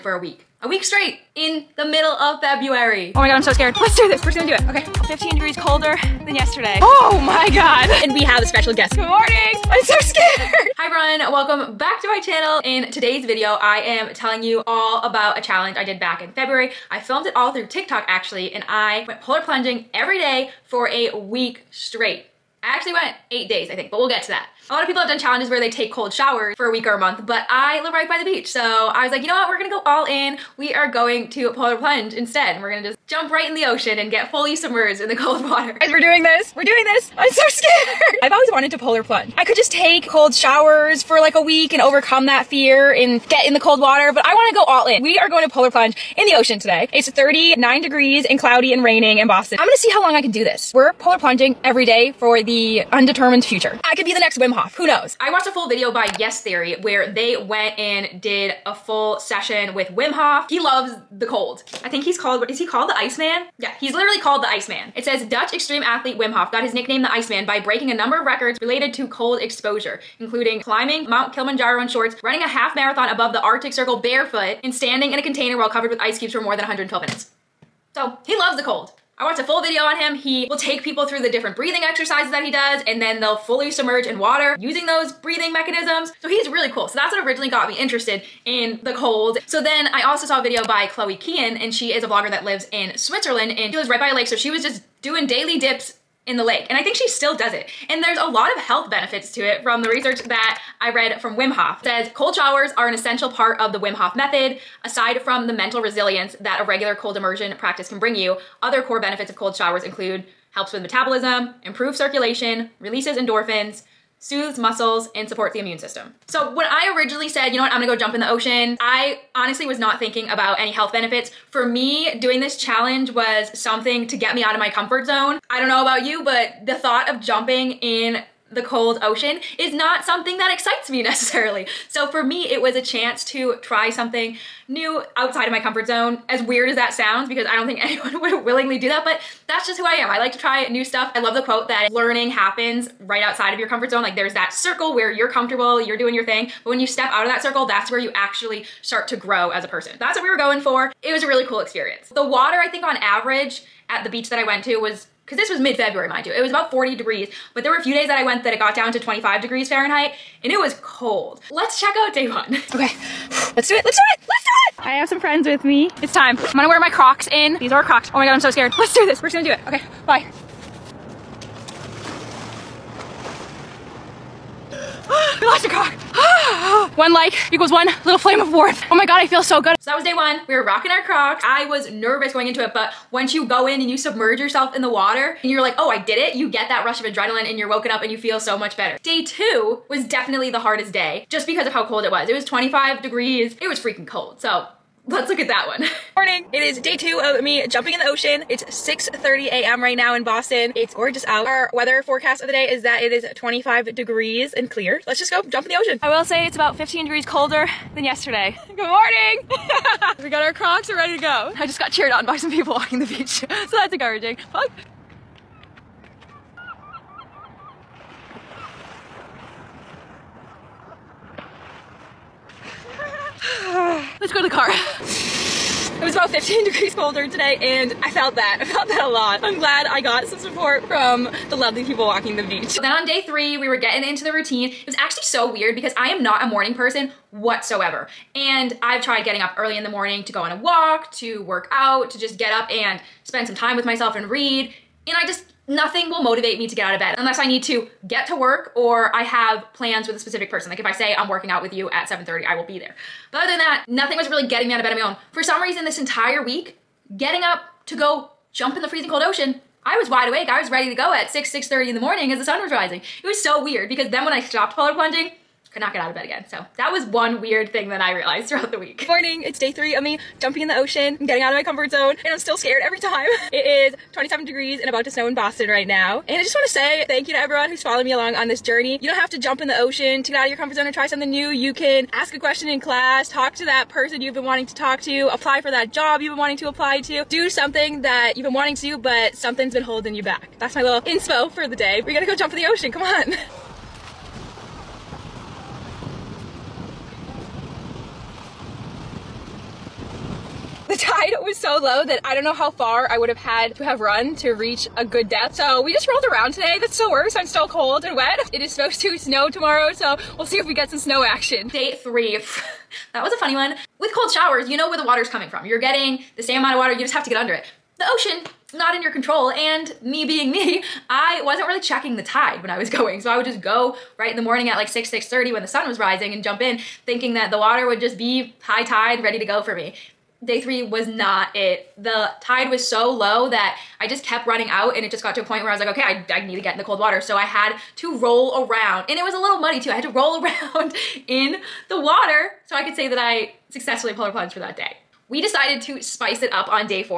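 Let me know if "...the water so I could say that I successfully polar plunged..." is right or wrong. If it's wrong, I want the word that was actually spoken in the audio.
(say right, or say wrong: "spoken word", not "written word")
right.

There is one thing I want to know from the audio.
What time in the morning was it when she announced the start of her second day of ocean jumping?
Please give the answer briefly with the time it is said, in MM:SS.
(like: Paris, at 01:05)
6:30 a.m., at 03:18.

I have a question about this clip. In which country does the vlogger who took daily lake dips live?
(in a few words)
Switzerland.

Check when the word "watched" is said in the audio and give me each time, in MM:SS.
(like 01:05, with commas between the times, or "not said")
00:55, 01:19.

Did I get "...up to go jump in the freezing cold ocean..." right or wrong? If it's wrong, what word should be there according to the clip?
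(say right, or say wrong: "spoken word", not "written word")
right.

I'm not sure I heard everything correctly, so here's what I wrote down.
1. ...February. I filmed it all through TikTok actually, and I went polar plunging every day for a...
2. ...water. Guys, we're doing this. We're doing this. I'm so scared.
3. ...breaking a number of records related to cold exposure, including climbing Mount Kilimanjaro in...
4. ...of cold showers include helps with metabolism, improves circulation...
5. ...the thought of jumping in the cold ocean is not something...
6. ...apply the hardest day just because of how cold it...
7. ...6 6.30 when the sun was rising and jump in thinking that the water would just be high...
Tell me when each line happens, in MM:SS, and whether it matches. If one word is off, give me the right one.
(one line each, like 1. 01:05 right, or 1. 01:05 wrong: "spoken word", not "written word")
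1. 00:16 right
2. 00:35 right
3. 01:07 right
4. 01:49 right
5. 02:06 right
6. 03:10 wrong: "definitely", not "apply"
7. 05:24 right.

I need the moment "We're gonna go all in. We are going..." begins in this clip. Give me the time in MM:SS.
00:29.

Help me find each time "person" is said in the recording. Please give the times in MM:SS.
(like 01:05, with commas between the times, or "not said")
02:29, 03:56, 04:10, 04:43.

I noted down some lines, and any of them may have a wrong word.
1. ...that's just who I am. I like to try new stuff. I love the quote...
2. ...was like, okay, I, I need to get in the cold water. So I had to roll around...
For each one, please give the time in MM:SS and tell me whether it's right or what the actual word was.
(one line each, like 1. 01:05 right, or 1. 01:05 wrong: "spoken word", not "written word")
1. 02:19 right
2. 05:35 right.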